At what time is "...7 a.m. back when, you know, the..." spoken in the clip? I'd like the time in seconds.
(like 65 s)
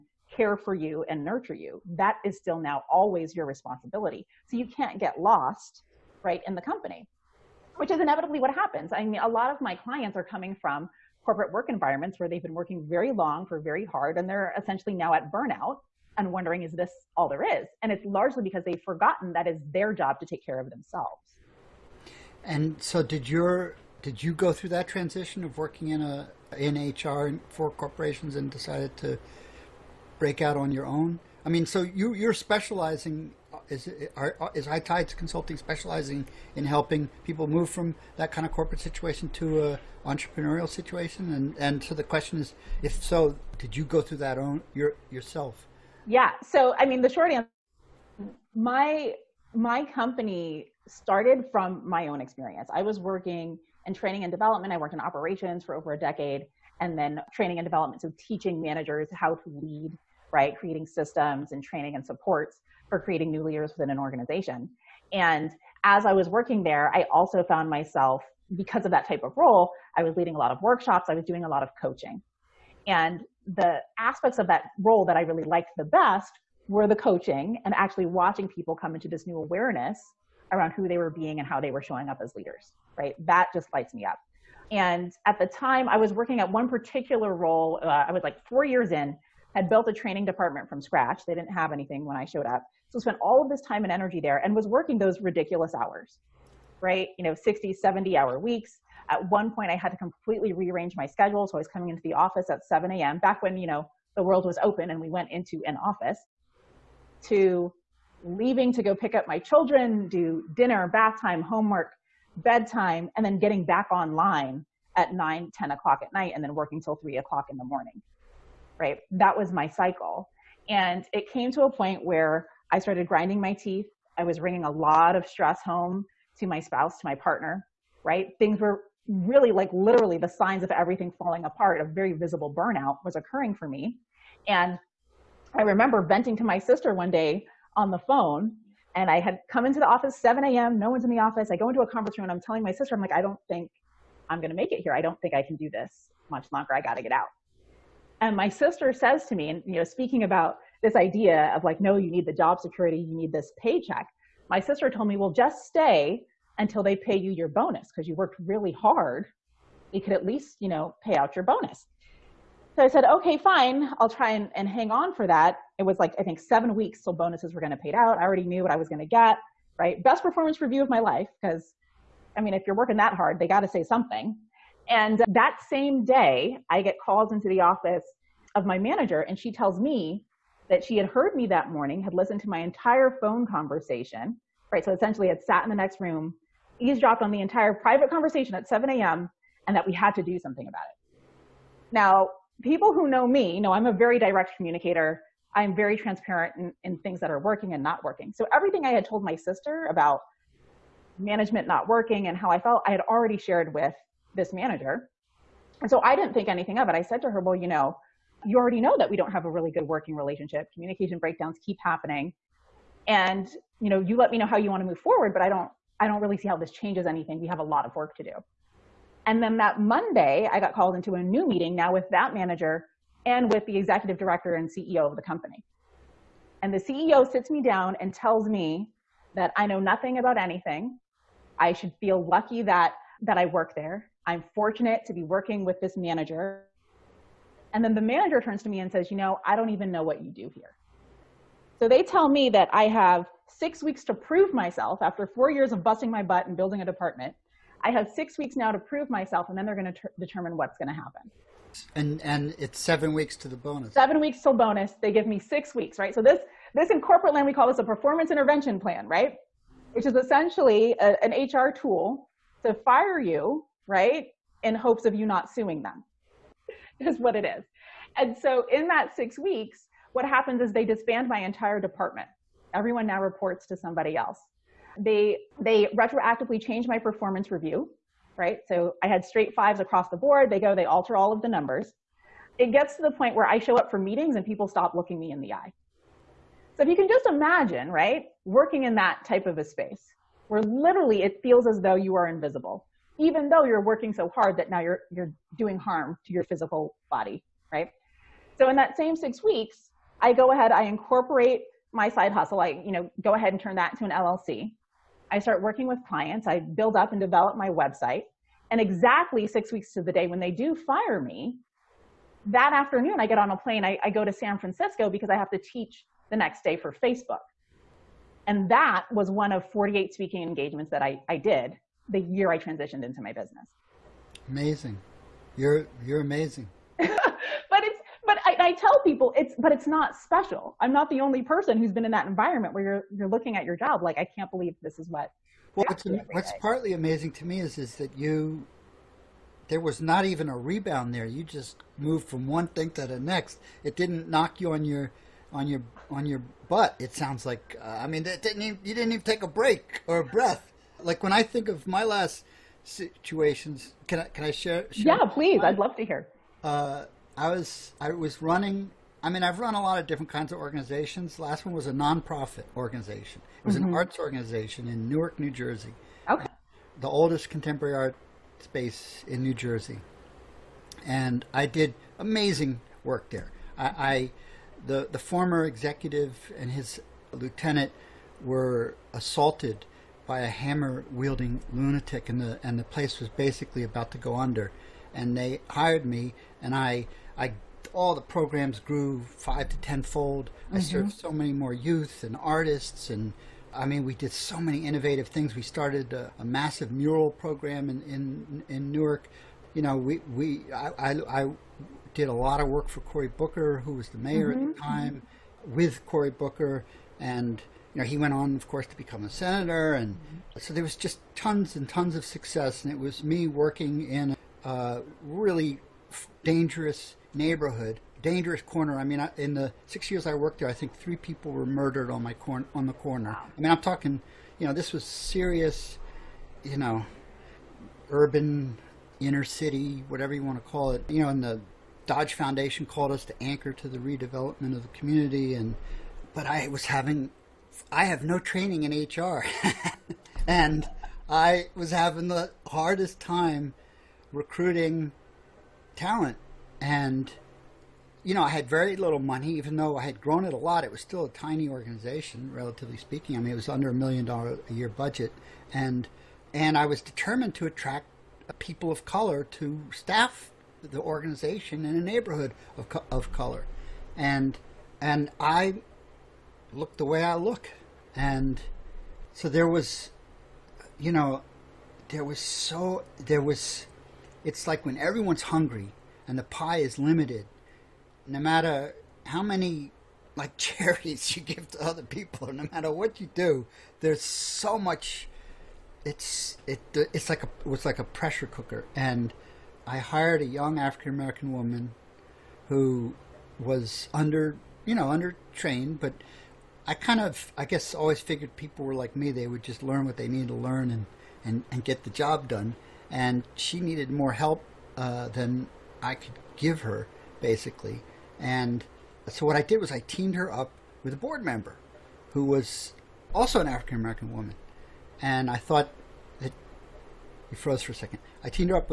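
102 s.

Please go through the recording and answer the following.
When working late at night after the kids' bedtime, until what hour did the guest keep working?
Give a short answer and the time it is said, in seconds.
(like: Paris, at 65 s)
3 o'clock, at 116 s.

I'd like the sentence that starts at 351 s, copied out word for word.
Like when I think of my last situations, can I can I share?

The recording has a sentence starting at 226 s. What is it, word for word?
And the CEO sits me down and tells me that I know nothing about anything.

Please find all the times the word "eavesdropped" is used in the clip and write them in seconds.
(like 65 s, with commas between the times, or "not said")
186 s.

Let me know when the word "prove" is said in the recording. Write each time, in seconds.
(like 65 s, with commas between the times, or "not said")
244 s, 248 s.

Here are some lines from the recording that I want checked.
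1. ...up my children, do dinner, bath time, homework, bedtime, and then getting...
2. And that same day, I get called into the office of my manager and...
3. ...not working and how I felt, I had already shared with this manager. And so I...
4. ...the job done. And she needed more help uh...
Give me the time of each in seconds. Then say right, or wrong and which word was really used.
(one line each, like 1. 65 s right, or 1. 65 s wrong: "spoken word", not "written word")
1. 109 s right
2. 174 s right
3. 201 s right
4. 502 s right.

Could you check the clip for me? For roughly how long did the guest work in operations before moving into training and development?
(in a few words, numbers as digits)
over a decade.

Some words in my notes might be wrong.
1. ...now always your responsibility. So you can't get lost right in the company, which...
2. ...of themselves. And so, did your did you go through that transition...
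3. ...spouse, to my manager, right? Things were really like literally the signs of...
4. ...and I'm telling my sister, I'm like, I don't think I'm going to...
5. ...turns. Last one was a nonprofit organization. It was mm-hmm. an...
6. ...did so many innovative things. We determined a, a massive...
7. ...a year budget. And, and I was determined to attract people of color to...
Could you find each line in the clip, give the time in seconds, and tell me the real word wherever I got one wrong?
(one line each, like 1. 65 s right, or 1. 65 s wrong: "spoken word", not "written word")
1. 2 s right
2. 20 s right
3. 126 s wrong: "partner", not "manager"
4. 142 s right
5. 360 s wrong: "organizations", not "turns"
6. 394 s wrong: "started", not "determined"
7. 454 s right.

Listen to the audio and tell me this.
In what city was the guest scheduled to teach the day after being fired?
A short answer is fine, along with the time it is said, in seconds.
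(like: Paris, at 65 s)
San Francisco, at 314 s.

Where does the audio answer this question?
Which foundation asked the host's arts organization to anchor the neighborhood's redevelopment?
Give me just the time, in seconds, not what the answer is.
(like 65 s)
432 s.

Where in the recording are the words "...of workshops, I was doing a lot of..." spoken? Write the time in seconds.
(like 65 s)
70 s.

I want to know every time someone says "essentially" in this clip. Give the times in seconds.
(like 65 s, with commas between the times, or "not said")
14 s, 184 s, 260 s.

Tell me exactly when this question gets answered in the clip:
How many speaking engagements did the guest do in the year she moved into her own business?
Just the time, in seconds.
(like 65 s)
319 s.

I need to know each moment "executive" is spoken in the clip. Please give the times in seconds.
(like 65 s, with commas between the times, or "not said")
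223 s, 375 s.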